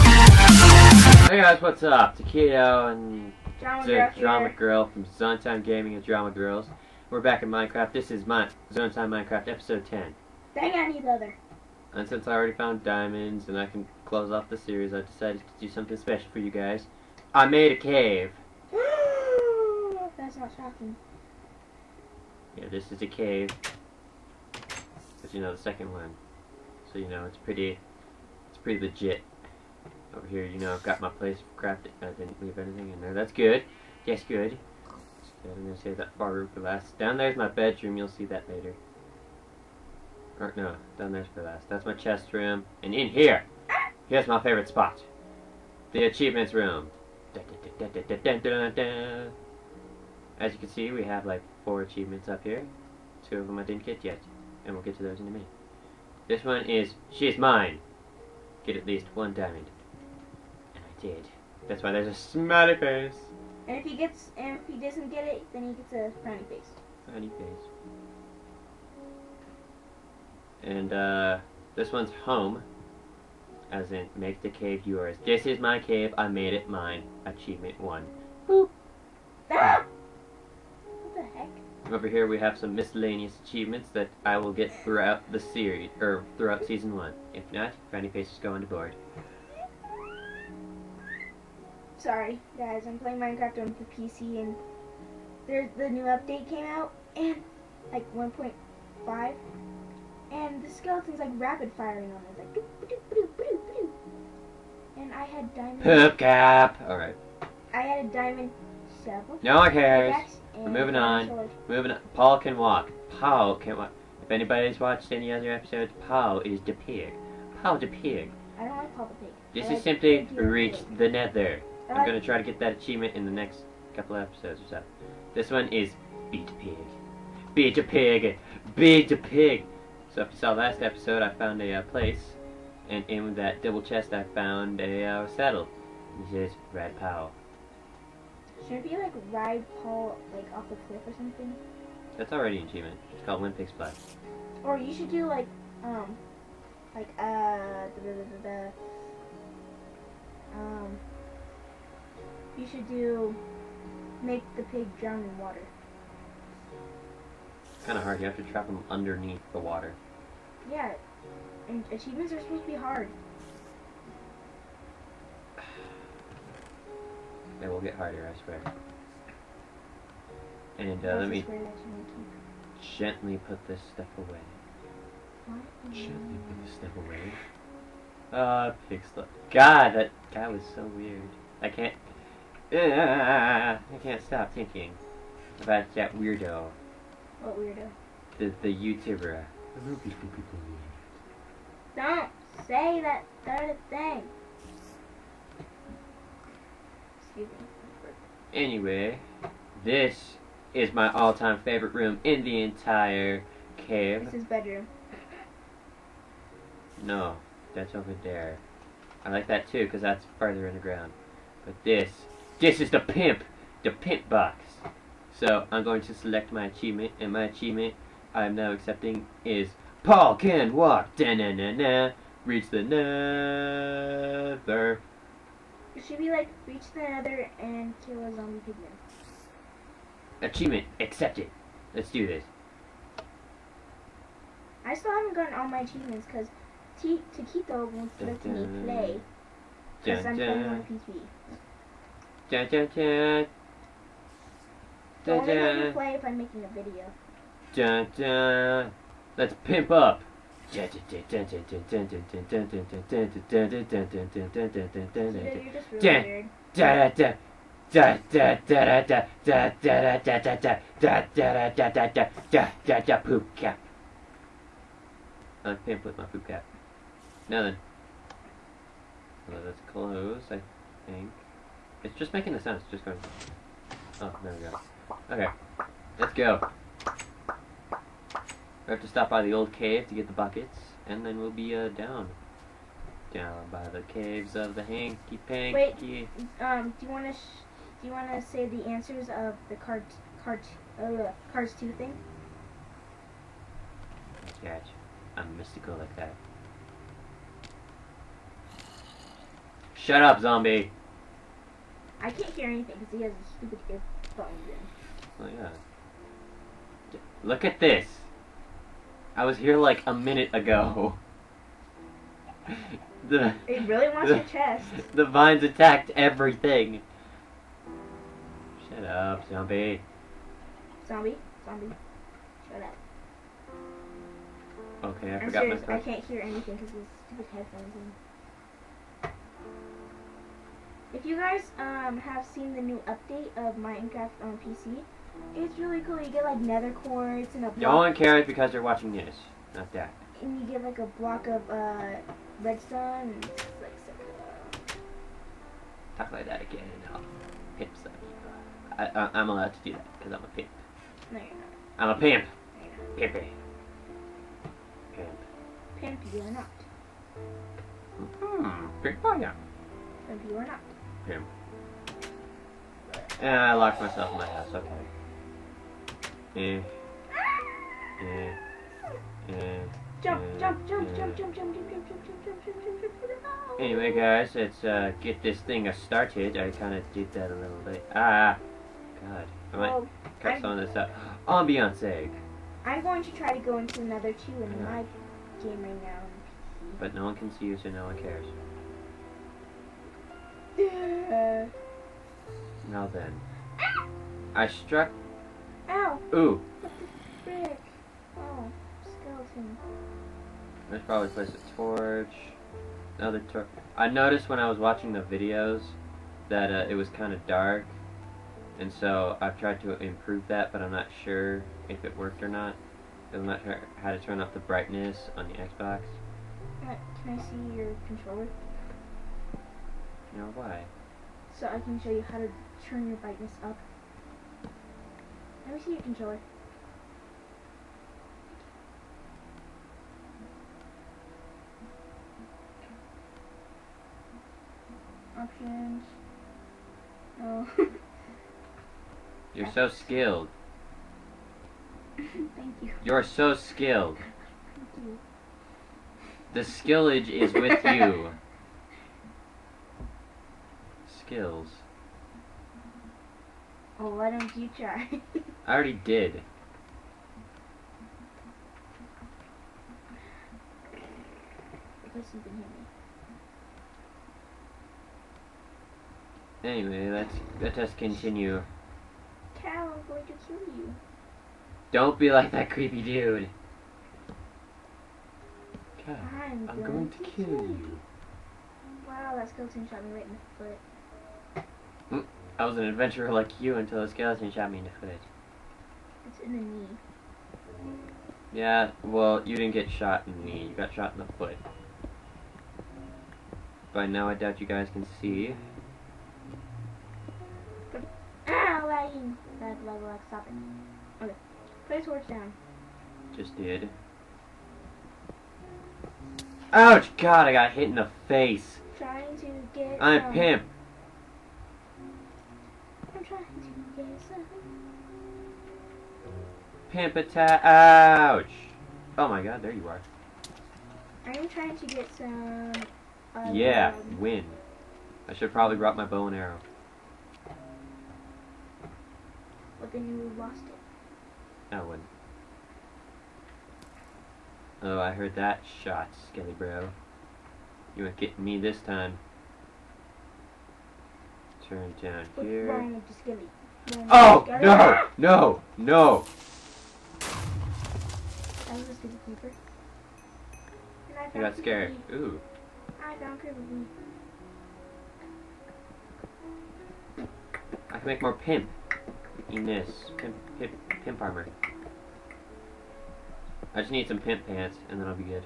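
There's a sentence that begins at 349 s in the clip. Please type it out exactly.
I, I, am allowed to do that because I'm a pimp.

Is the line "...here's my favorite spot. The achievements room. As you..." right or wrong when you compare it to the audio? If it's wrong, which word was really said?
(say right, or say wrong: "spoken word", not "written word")
right.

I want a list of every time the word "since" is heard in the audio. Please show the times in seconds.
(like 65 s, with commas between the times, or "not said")
12 s.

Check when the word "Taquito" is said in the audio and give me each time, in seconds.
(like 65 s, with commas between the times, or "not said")
2 s, 237 s.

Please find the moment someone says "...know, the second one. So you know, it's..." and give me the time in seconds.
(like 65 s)
25 s.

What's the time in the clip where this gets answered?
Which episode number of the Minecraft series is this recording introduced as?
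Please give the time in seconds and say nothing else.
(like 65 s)
9 s.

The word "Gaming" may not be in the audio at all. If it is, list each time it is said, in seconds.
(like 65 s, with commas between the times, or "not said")
5 s.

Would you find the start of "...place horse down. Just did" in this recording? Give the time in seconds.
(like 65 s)
501 s.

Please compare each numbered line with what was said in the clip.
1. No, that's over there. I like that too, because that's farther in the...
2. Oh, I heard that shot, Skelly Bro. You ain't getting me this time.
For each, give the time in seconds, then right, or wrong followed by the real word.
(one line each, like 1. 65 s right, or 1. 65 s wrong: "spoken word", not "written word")
1. 207 s right
2. 534 s right.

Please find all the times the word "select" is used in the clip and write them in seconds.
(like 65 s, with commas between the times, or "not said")
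216 s.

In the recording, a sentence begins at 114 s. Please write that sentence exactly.
If anybody's watched any other episodes, Paul is the pig.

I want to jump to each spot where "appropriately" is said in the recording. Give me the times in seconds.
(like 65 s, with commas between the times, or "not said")
not said.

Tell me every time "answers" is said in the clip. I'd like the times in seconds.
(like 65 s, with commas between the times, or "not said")
288 s.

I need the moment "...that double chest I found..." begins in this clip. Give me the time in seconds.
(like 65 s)
133 s.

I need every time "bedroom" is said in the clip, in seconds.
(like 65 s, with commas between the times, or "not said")
37 s, 204 s.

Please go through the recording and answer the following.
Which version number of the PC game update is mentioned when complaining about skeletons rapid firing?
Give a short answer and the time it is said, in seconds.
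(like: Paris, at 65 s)
1.5, at 98 s.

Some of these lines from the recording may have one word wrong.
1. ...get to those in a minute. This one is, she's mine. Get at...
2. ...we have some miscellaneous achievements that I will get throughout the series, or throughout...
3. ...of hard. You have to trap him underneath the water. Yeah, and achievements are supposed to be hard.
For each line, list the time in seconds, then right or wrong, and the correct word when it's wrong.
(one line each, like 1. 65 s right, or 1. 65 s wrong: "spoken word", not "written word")
1. 54 s right
2. 82 s right
3. 157 s right.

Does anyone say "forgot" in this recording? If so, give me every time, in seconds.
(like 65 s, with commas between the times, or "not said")
325 s.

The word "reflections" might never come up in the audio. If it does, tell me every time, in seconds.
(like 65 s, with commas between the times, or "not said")
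not said.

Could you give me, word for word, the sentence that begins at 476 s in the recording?
Cow, I'm, I'm going, going, to, kill, kill you.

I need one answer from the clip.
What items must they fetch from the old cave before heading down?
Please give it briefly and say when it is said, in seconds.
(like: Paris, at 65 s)
buckets, at 280 s.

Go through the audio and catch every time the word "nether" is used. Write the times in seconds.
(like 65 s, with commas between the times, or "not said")
121 s, 222 s, 227 s, 336 s.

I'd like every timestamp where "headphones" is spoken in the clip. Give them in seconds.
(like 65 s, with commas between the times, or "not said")
303 s, 327 s.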